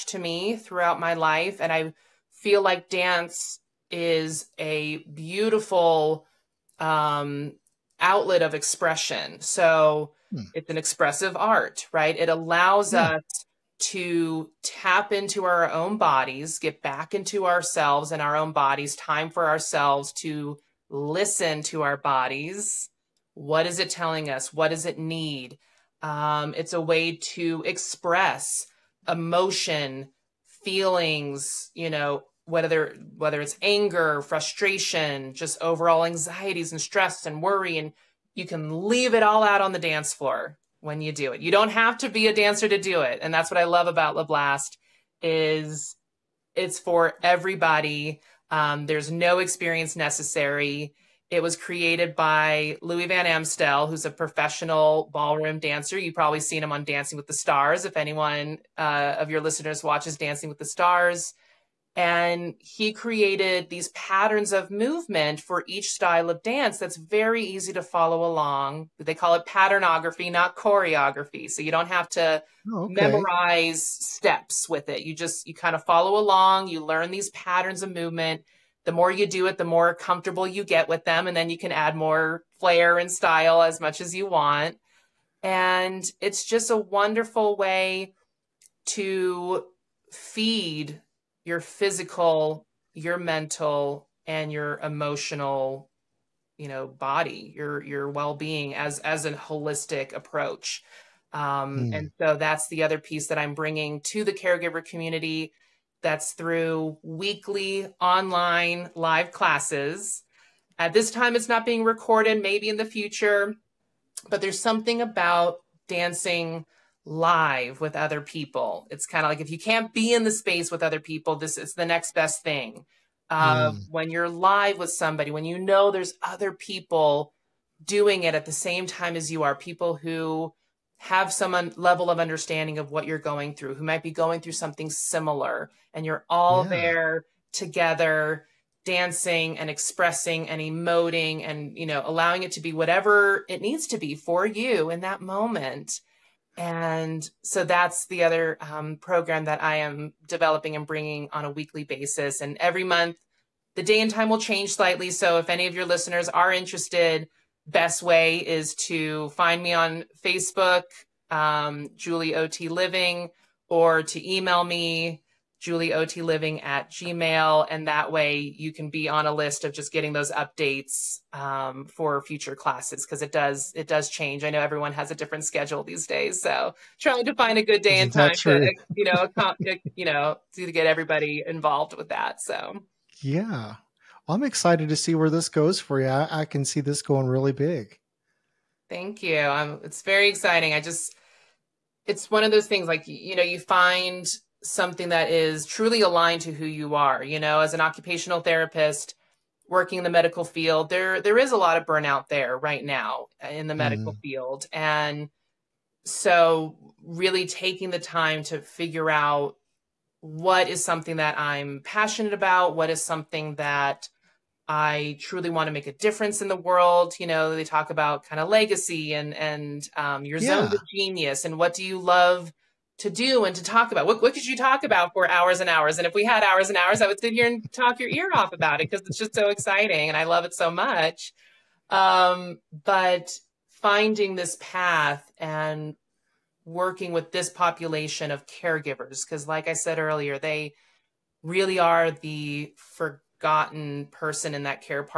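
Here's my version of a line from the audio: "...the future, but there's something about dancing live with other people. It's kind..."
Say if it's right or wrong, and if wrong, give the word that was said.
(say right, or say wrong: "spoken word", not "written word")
right.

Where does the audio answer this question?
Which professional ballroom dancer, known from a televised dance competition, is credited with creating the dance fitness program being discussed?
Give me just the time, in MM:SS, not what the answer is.
00:52.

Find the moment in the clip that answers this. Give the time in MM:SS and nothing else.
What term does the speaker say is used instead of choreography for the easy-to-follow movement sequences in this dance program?
01:09.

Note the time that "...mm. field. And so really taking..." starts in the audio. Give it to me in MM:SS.
03:24.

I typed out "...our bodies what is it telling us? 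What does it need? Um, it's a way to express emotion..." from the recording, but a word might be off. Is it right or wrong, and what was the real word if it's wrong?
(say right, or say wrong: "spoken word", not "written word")
right.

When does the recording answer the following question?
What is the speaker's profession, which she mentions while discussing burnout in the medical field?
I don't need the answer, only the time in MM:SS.
03:17.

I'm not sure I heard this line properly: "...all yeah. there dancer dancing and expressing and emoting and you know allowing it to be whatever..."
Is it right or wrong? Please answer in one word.
wrong.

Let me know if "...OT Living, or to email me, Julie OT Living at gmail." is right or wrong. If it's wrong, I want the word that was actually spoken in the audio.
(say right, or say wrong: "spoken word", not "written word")
right.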